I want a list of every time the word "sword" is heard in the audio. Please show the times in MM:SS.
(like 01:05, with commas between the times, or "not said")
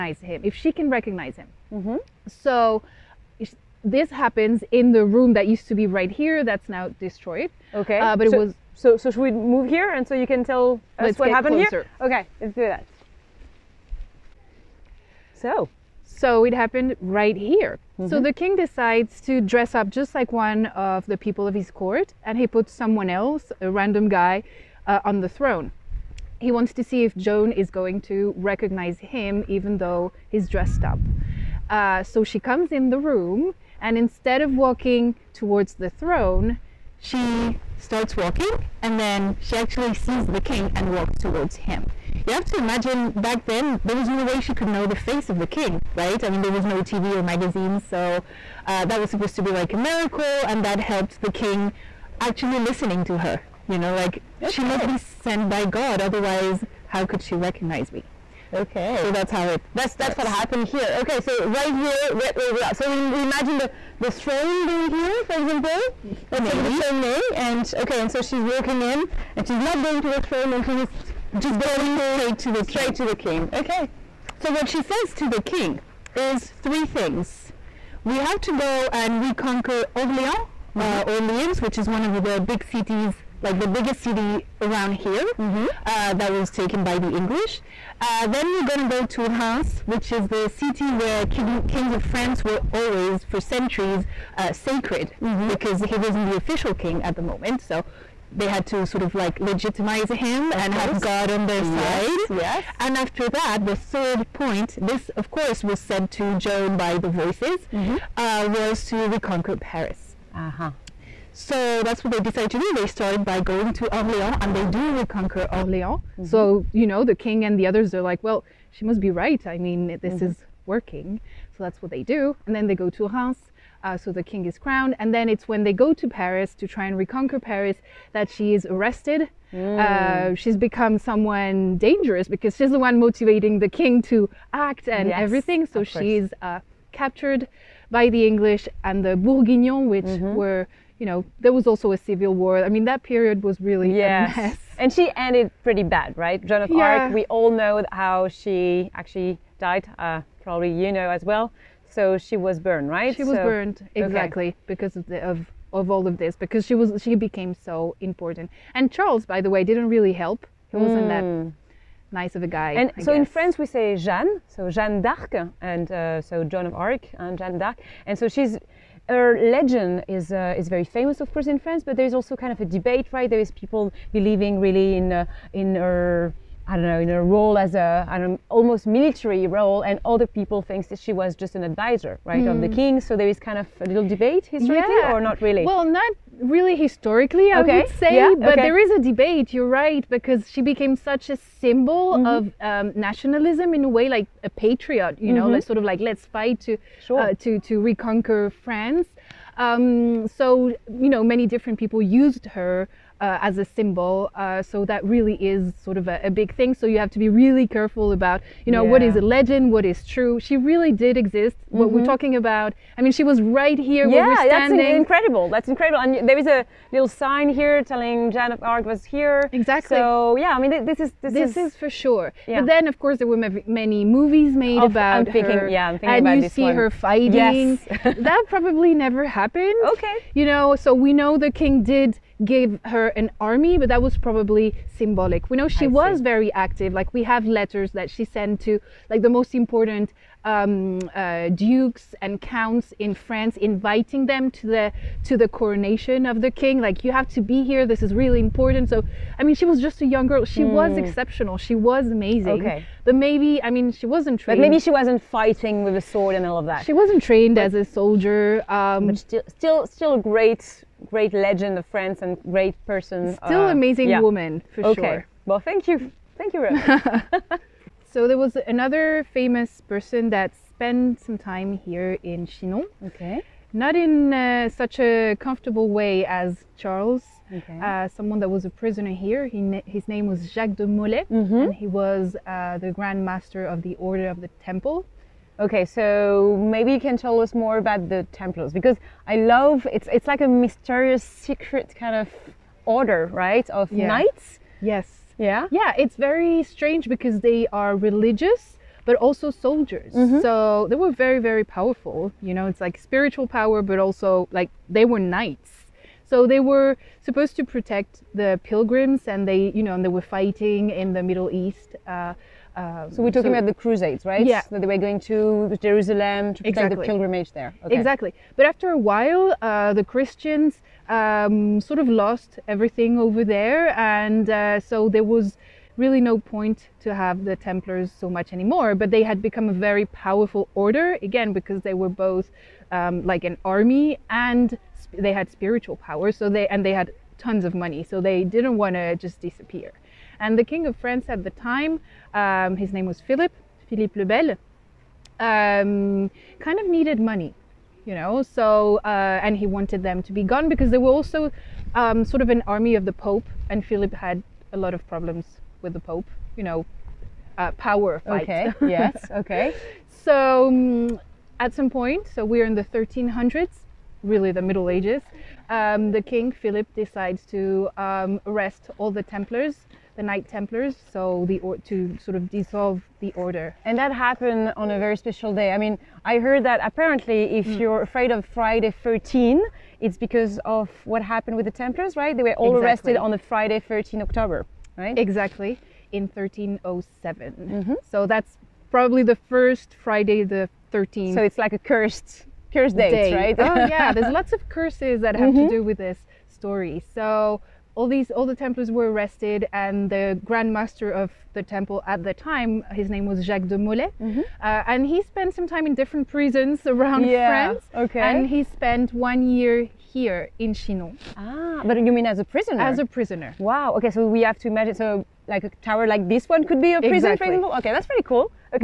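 04:16.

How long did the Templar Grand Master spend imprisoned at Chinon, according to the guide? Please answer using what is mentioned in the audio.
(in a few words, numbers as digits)
one year.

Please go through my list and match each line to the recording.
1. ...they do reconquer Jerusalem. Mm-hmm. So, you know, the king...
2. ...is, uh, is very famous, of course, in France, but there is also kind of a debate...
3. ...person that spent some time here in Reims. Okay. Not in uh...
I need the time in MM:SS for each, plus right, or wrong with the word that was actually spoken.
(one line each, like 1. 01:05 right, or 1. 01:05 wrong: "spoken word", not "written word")
1. 01:54 wrong: "Orléans", not "Jerusalem"
2. 02:50 right
3. 04:29 wrong: "Chinon", not "Reims".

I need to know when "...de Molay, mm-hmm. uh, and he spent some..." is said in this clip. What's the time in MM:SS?
06:43.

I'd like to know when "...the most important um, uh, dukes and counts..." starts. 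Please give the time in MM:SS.
03:59.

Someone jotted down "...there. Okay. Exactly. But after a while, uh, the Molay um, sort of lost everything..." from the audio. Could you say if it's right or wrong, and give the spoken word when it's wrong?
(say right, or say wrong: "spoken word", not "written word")
wrong: "Christians", not "Molay".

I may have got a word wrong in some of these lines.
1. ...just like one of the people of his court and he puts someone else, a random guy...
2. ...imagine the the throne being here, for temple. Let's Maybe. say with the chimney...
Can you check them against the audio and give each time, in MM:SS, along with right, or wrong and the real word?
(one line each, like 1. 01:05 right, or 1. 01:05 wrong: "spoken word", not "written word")
1. 00:19 right
2. 01:03 wrong: "example", not "temple".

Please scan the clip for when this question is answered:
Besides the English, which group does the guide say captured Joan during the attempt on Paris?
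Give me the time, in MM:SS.
02:19.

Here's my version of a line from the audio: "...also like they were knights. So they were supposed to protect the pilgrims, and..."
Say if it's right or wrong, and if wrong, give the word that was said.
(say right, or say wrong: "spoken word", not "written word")
right.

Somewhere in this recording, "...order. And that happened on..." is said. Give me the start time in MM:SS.
06:13.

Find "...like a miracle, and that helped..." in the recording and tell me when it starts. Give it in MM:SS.
00:49.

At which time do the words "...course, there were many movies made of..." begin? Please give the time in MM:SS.
03:42.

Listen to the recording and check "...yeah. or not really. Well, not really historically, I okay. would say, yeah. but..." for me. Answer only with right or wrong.
right.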